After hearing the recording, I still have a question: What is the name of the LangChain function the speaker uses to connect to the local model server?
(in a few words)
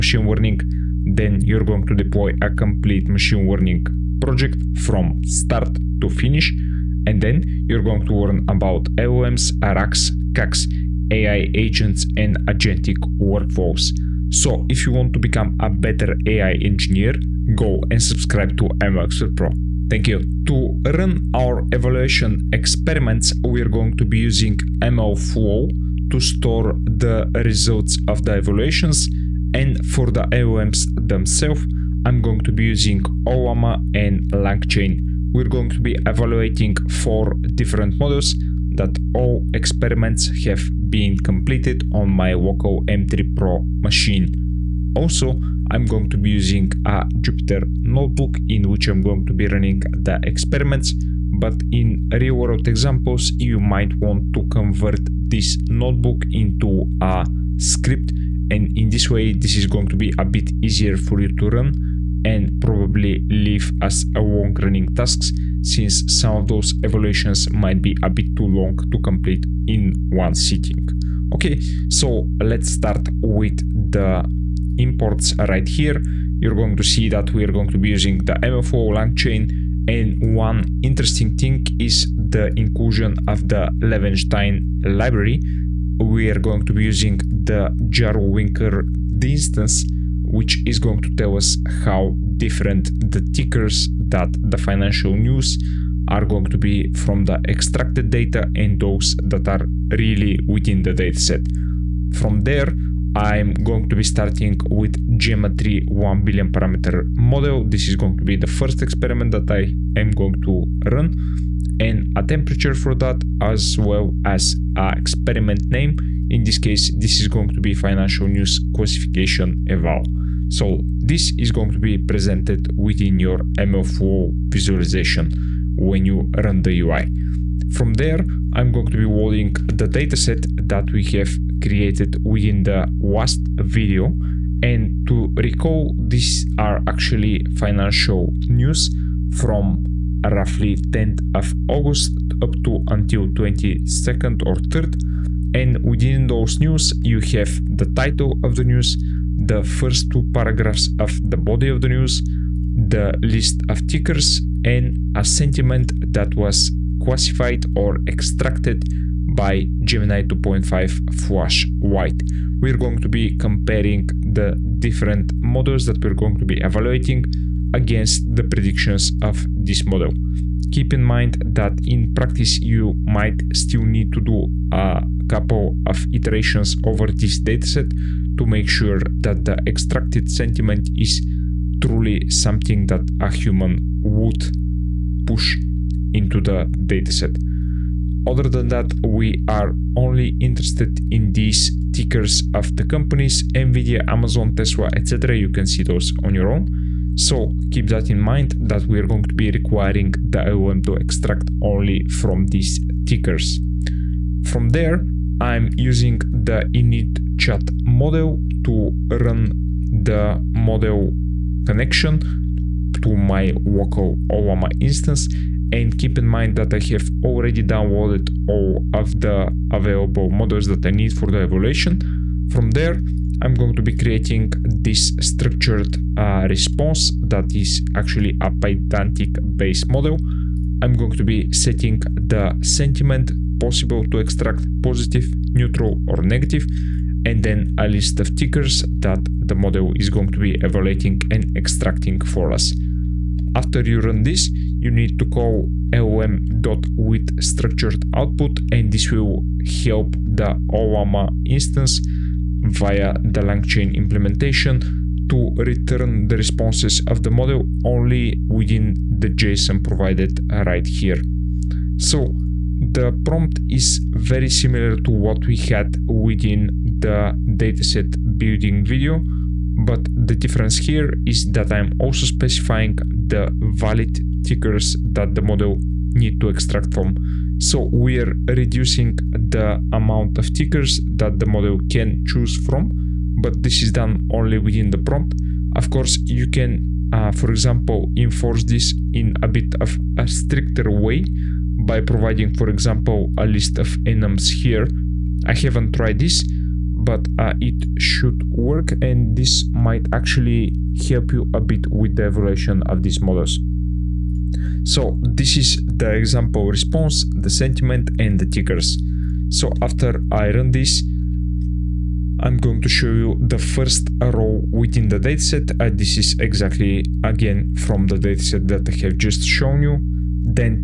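init chat model.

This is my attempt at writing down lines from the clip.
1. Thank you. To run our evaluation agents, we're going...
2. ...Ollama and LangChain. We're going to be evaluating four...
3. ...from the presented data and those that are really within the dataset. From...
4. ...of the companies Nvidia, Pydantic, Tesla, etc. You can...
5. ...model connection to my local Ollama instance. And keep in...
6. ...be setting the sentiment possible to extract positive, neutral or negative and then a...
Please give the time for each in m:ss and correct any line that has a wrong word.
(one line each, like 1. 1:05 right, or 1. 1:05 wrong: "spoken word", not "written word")
1. 0:19 wrong: "experiments", not "agents"
2. 0:33 right
3. 1:36 wrong: "extracted", not "presented"
4. 3:12 wrong: "Amazon", not "Pydantic"
5. 3:30 right
6. 3:51 right.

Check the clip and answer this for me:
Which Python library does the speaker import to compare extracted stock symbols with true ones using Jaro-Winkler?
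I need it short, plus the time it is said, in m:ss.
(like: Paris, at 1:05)
Levenshtein, at 1:23.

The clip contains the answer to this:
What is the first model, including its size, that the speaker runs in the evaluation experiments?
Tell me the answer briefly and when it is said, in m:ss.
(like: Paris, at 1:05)
Gemma 3 1B, at 1:45.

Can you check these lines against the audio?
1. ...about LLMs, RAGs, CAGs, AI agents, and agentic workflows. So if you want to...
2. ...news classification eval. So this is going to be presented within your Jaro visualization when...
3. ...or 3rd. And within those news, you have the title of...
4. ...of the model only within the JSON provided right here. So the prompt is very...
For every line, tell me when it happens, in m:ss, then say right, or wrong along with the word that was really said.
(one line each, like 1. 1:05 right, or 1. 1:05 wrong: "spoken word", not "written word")
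1. 0:08 right
2. 1:58 wrong: "MLflow", not "Jaro"
3. 2:24 right
4. 4:17 right.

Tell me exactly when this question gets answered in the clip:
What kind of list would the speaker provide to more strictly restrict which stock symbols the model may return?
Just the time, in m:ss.
4:53.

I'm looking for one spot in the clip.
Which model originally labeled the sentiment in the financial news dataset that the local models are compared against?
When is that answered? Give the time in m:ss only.
2:39.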